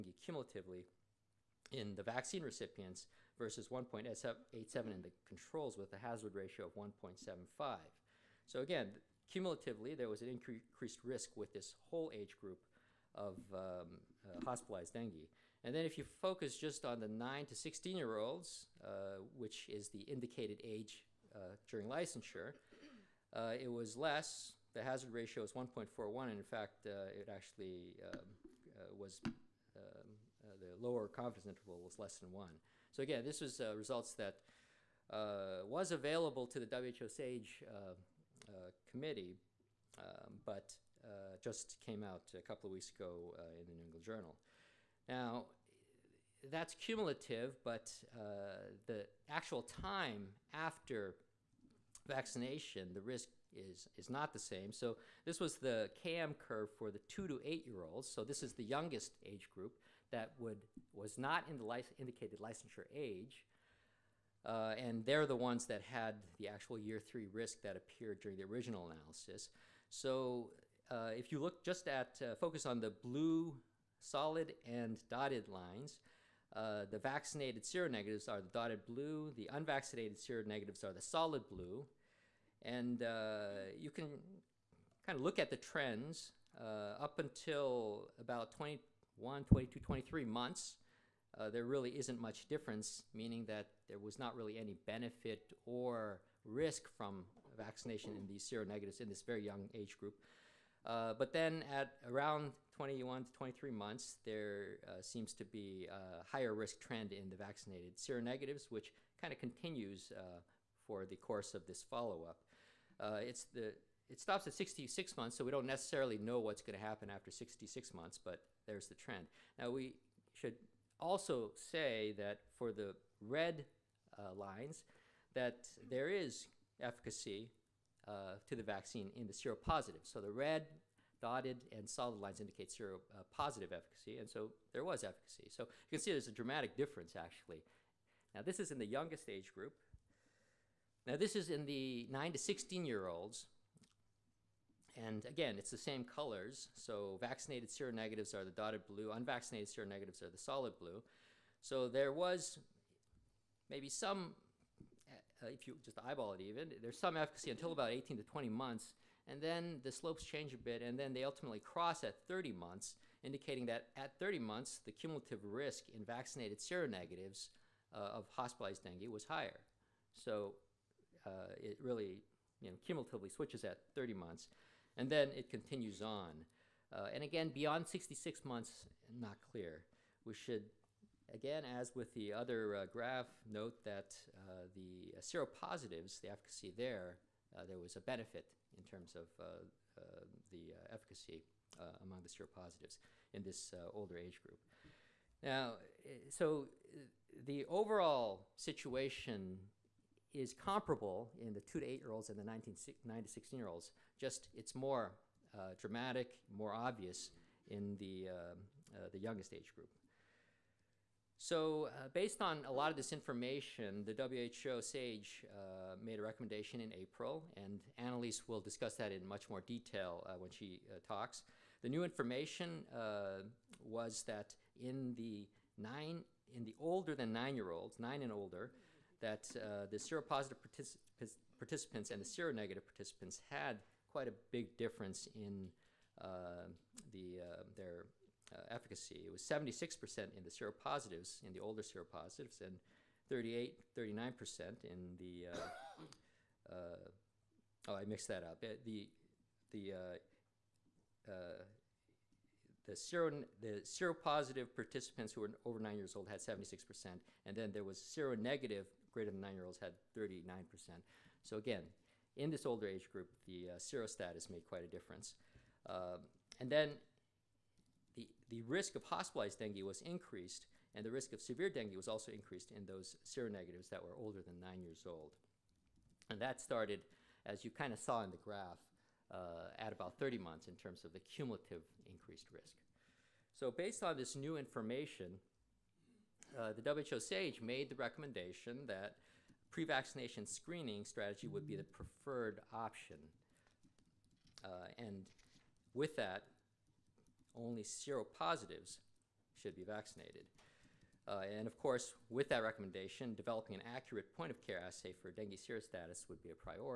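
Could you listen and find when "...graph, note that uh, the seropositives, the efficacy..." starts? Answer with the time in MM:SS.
03:02.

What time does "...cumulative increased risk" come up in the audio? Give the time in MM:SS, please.
04:41.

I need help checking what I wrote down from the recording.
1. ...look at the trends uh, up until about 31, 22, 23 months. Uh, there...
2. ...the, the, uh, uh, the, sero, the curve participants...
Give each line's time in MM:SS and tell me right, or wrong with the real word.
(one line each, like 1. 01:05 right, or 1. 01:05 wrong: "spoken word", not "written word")
1. 01:25 wrong: "21", not "31"
2. 04:08 wrong: "seropositive", not "curve".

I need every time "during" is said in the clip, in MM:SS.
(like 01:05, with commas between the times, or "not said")
00:21, 01:08.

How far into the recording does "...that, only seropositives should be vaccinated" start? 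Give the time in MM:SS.
04:56.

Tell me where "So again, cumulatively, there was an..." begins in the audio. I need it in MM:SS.
00:08.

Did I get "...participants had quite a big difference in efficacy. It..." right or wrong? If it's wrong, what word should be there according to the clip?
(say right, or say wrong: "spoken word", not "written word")
right.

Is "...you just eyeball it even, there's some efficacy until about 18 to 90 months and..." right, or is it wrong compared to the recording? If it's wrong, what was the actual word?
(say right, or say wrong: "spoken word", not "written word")
wrong: "20", not "90".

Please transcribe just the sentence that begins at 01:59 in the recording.
Now we should also say that for the red uh, lines, that there is efficacy uh, to the vaccine in the seropositive.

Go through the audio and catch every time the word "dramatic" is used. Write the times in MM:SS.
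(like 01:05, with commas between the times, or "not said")
02:16, 03:25.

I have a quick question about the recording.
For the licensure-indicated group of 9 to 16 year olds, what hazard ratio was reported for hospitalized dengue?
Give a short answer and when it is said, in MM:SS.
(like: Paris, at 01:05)
1.41, at 00:25.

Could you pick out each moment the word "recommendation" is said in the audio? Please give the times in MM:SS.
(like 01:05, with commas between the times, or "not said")
03:36, 04:47, 05:02.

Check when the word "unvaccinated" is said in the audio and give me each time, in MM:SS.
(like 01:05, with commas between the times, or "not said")
01:19, 02:29.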